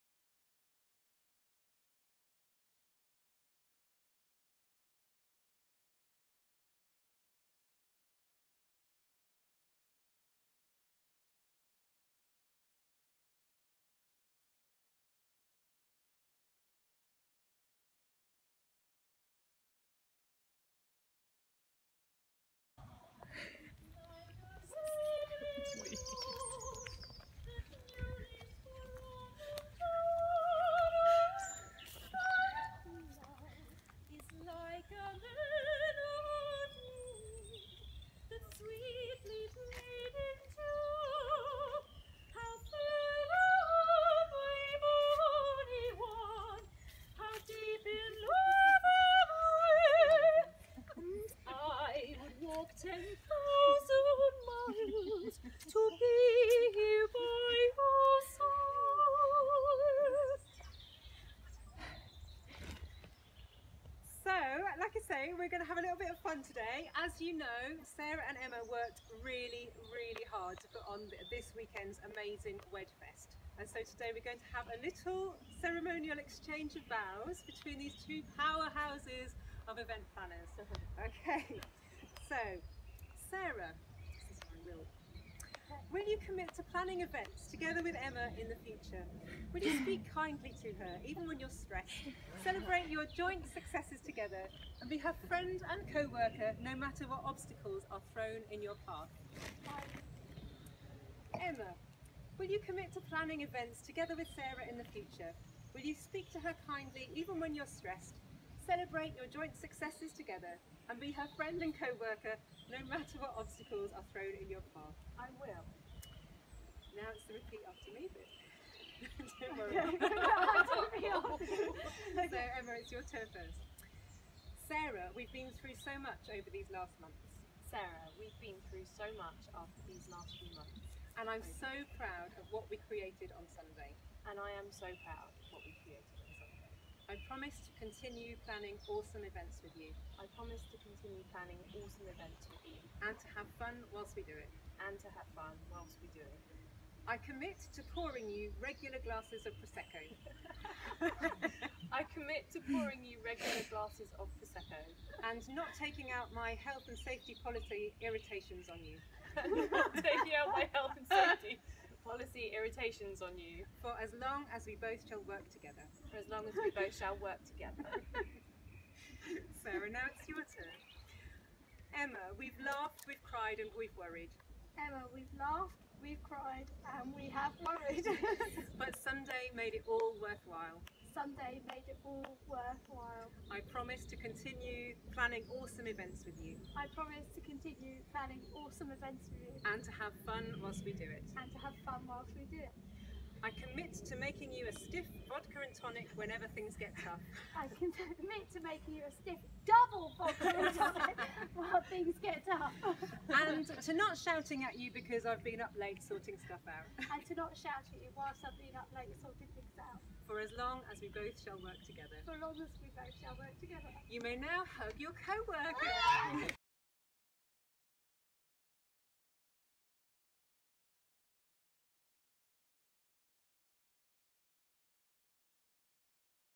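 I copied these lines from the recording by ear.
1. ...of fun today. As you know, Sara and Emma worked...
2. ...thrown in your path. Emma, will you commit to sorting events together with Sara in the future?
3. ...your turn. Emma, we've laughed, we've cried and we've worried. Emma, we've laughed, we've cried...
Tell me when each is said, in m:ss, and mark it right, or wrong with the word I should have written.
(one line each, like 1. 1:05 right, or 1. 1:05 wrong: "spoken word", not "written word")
1. 1:06 right
2. 1:38 wrong: "planning", not "sorting"
3. 2:50 right.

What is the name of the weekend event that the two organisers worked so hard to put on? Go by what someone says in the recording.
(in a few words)
Wedfest.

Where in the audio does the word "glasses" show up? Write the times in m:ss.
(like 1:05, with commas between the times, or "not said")
2:29, 2:33.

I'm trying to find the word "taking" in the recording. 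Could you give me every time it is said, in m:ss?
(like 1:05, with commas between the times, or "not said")
2:35, 2:39.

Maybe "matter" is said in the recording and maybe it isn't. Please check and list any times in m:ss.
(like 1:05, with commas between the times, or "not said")
1:36, 1:52.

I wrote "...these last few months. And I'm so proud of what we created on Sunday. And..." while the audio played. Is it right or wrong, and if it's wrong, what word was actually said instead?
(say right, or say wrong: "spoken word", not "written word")
right.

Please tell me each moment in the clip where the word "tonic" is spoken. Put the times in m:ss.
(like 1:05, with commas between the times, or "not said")
3:15, 3:20.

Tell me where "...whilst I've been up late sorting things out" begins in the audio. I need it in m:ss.
3:28.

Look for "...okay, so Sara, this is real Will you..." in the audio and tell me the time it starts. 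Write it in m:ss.
1:21.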